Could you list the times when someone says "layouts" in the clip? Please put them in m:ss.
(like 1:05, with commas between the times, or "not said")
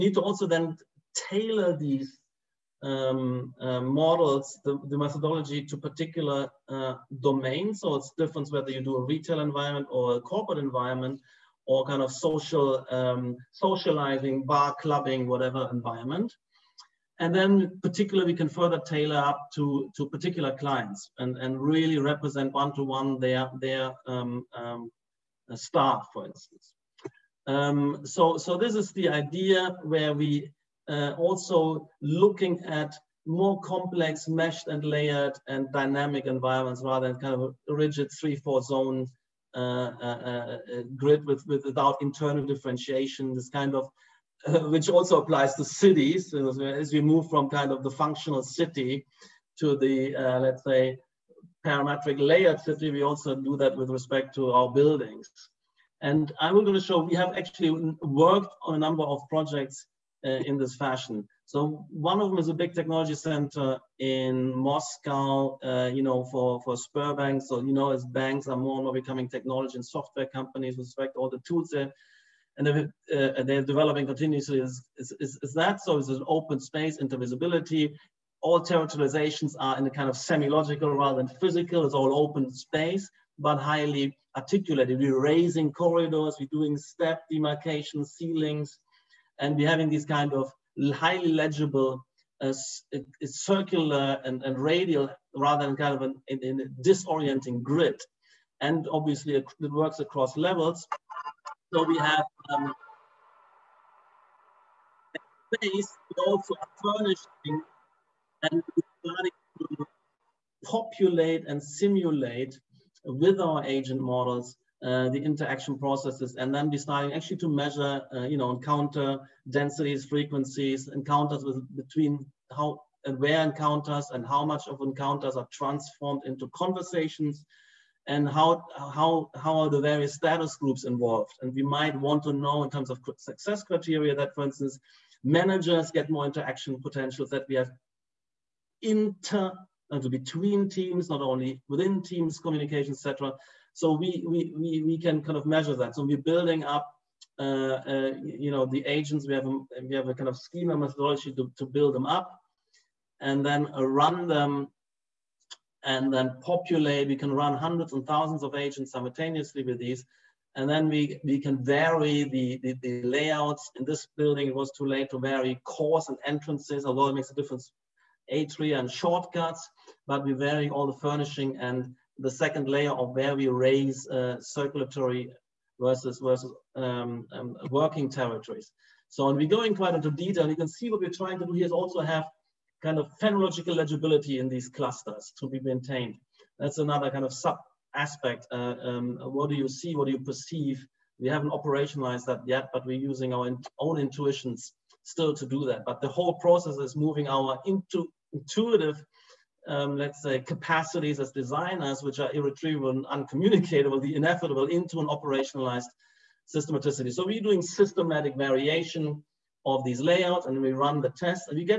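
2:43, 3:29.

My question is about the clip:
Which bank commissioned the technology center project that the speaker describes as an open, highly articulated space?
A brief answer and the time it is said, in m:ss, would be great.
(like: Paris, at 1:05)
Sberbank, at 1:06.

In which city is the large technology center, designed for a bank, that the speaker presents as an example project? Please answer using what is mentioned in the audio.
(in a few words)
Moscow.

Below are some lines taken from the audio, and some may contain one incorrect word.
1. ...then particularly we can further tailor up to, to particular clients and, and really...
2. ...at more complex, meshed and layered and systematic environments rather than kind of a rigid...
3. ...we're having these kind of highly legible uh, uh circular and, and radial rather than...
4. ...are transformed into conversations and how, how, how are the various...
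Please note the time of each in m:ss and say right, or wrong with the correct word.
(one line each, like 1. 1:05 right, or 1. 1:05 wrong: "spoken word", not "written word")
1. 0:17 right
2. 0:32 wrong: "dynamic", not "systematic"
3. 1:29 right
4. 2:05 right.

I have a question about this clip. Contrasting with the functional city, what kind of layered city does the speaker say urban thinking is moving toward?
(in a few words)
parametric layered city.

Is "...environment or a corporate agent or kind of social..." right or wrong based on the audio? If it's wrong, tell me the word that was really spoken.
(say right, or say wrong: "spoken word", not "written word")
wrong: "environment", not "agent".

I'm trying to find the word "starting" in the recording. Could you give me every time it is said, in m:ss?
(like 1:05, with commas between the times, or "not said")
1:49.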